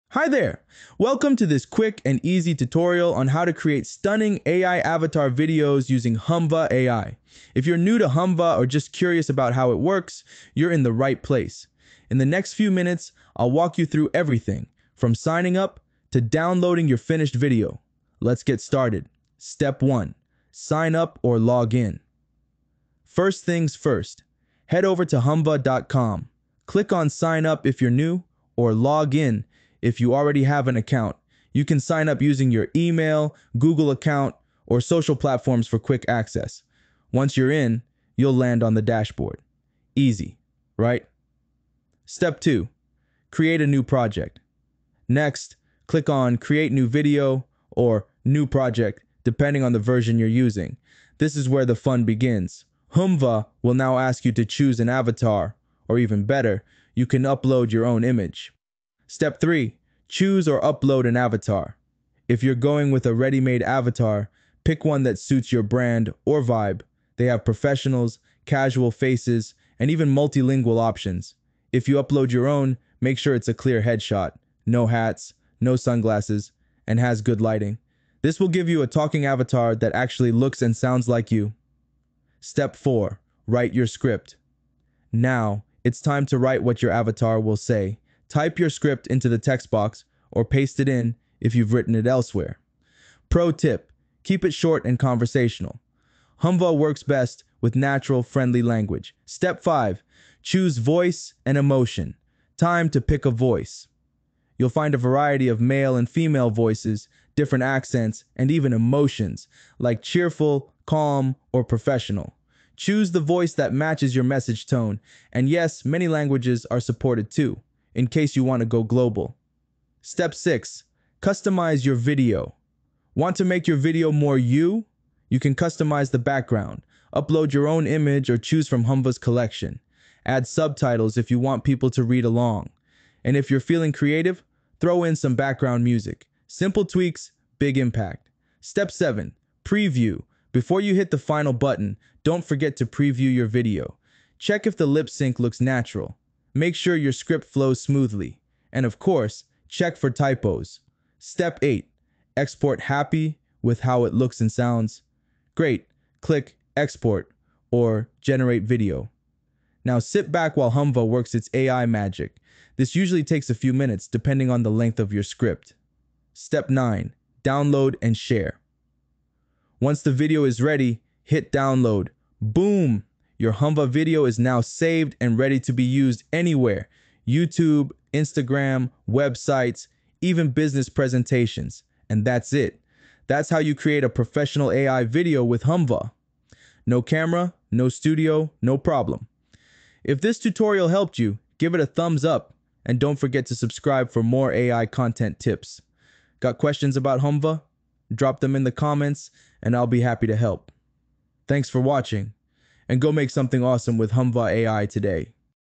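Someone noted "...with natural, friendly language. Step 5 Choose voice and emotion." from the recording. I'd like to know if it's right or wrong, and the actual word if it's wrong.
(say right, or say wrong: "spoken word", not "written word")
right.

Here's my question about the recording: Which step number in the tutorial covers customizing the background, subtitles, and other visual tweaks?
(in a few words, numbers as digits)
6.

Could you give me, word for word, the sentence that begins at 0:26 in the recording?
Click on sign up if you're new, or log in if you already have an account.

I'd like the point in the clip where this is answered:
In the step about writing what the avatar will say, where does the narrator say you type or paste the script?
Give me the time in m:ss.
1:29.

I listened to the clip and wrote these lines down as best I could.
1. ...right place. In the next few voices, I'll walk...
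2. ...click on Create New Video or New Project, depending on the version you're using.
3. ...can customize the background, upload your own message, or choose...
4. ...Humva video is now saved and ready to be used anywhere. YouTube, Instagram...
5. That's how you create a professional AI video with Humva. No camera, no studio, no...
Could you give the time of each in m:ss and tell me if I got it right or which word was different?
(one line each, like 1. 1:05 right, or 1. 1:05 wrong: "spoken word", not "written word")
1. 0:10 wrong: "minutes", not "voices"
2. 0:45 right
3. 2:05 wrong: "image", not "message"
4. 2:53 right
5. 3:03 right.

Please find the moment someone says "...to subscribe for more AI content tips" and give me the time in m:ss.
3:13.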